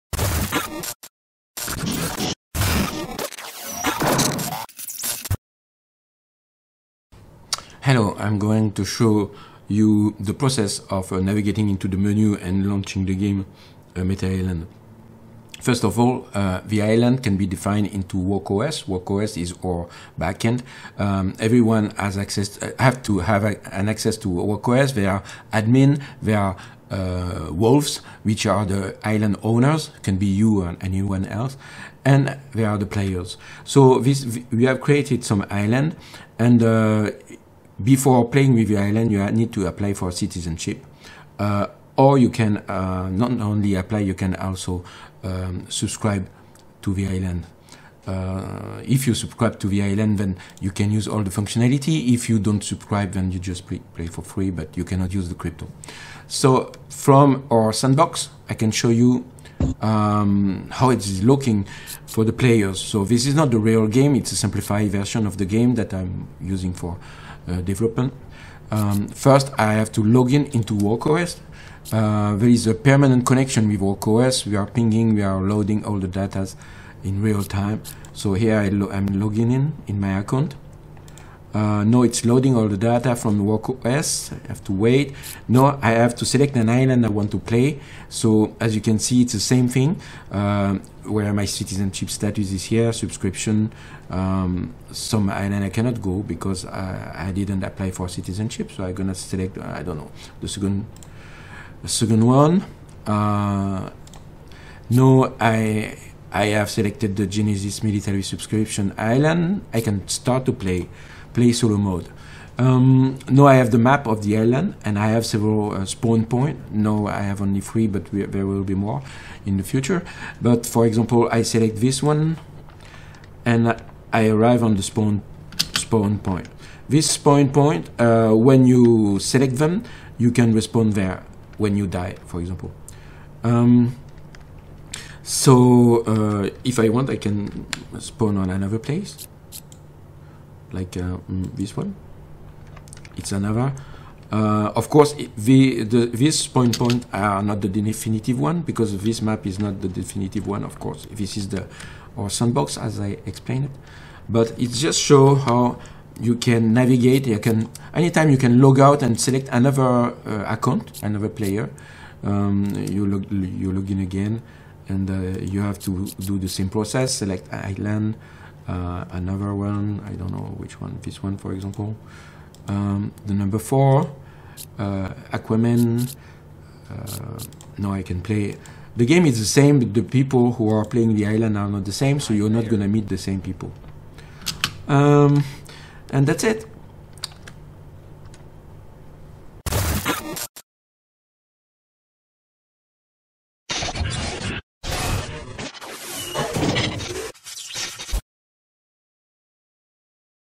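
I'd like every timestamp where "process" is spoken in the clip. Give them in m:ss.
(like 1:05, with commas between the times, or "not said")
0:10, 2:46.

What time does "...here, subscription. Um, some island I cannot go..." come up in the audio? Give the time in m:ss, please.
1:32.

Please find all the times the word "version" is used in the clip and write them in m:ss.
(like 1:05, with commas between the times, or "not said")
1:04.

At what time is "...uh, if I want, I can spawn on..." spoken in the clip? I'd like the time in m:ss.
2:16.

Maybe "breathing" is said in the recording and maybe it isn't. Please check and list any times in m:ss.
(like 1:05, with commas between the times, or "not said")
not said.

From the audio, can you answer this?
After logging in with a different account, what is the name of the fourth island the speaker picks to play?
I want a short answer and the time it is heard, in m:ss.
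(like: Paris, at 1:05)
Aquaman, at 2:55.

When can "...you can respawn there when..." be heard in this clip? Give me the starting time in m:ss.
2:10.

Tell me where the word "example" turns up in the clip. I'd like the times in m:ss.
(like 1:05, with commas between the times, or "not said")
2:00, 2:12, 2:51.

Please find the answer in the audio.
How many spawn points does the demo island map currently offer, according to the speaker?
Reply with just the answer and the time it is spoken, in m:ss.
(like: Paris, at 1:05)
3, at 1:57.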